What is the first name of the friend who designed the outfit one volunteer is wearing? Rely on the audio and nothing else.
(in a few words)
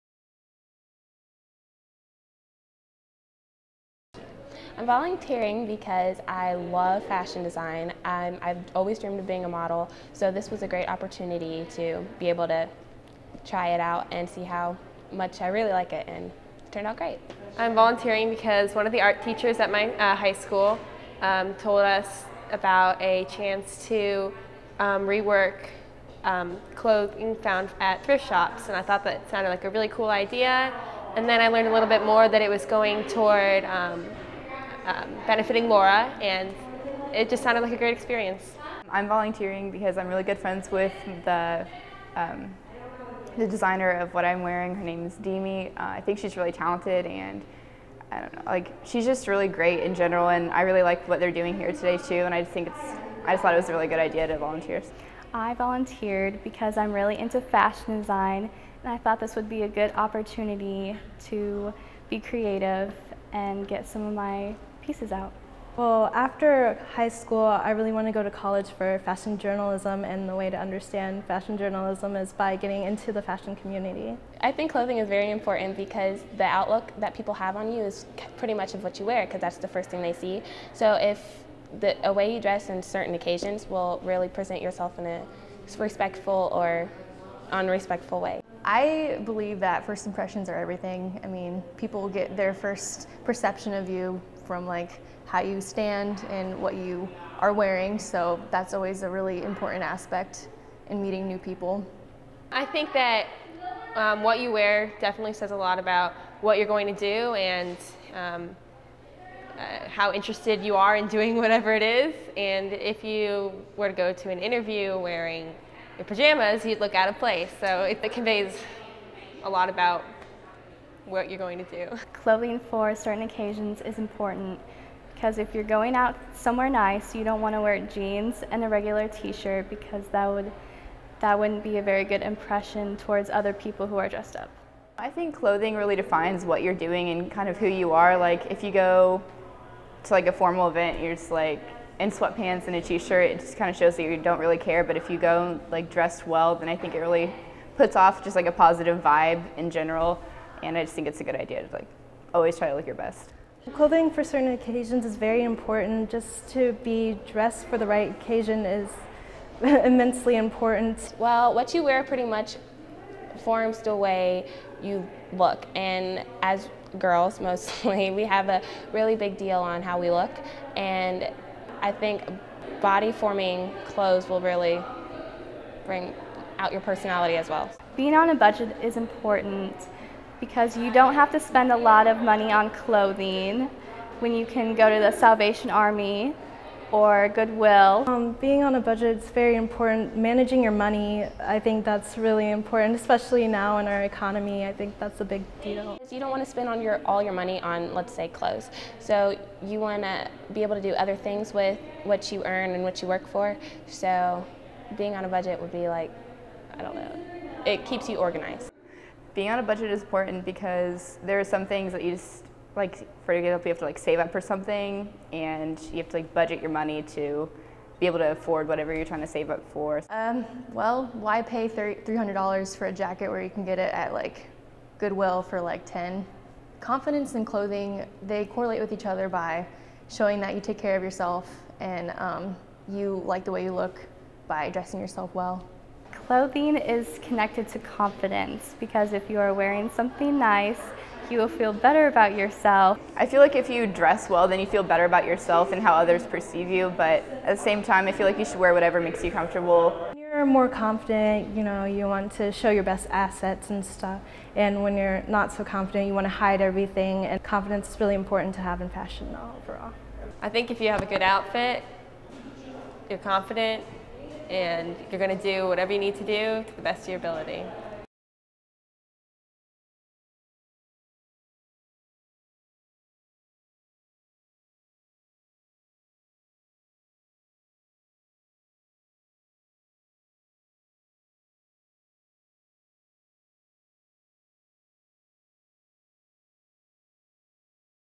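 Demi.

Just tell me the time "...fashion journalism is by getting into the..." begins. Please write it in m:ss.
1:11.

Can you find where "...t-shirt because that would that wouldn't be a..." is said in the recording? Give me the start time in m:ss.
2:09.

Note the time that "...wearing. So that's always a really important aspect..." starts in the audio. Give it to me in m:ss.
1:37.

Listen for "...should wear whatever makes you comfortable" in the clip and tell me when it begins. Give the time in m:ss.
4:08.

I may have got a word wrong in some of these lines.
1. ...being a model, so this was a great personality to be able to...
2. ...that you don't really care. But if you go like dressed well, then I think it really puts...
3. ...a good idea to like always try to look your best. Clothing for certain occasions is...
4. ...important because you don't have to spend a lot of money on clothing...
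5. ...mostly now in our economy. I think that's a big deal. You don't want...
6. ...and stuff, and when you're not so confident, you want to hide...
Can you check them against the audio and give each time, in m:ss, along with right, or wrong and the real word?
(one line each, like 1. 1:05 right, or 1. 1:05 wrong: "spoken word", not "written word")
1. 0:09 wrong: "opportunity", not "personality"
2. 2:23 right
3. 2:31 right
4. 2:58 right
5. 3:12 wrong: "especially", not "mostly"
6. 4:13 right.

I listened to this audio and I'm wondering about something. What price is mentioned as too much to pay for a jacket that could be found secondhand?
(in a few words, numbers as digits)
$300.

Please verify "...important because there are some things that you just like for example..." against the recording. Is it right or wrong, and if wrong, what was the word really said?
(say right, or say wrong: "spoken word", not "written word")
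right.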